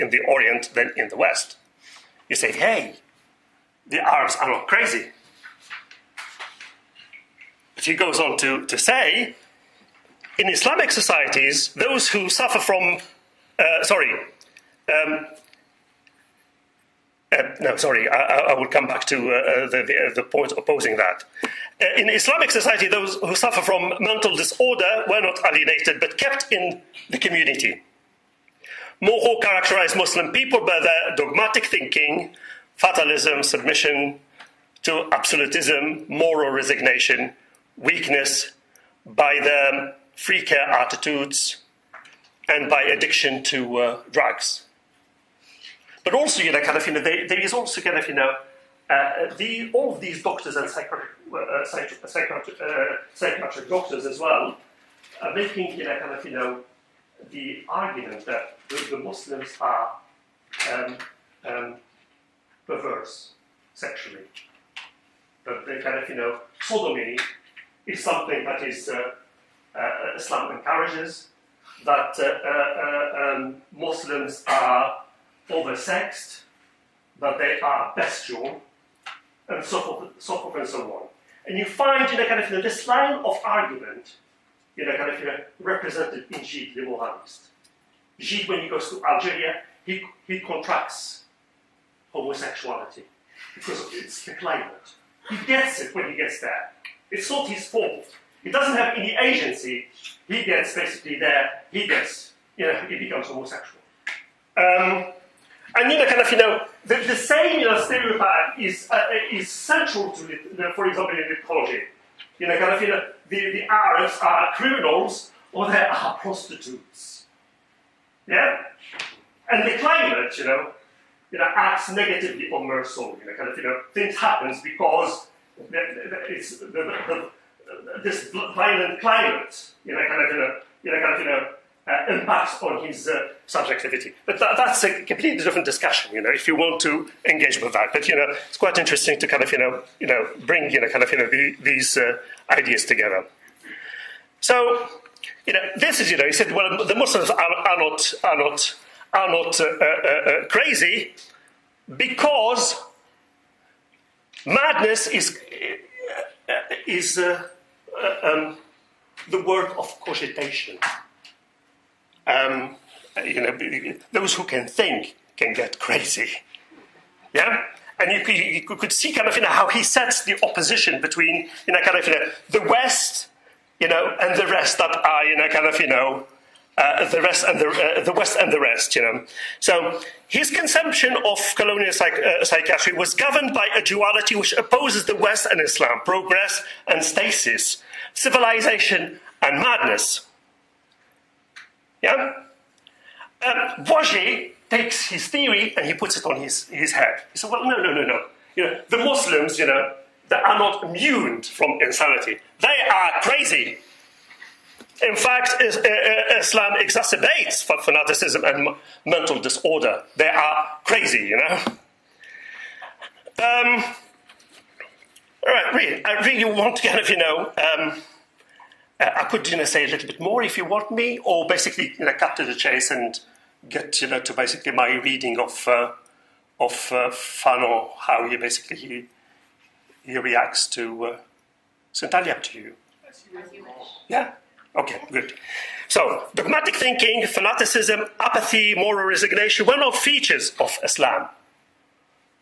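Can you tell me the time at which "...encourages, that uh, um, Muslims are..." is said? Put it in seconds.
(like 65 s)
70 s.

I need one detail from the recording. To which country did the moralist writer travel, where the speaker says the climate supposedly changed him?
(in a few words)
Algeria.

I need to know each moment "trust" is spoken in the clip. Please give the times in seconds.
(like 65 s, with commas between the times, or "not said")
not said.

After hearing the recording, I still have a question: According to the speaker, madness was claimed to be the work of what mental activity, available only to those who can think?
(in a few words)
cogitation.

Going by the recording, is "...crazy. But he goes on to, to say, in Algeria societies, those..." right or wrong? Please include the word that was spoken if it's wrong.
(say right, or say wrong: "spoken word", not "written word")
wrong: "Islamic", not "Algeria".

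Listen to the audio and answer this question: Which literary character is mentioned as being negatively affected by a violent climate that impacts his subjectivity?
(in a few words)
Meursault.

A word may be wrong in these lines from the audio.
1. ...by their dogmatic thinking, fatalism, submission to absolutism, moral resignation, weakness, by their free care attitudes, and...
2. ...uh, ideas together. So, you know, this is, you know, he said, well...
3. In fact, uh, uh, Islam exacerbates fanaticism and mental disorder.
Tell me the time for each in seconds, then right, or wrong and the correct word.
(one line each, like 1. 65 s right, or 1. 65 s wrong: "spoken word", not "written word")
1. 30 s right
2. 141 s right
3. 205 s right.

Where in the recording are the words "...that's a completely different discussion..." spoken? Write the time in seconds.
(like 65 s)
134 s.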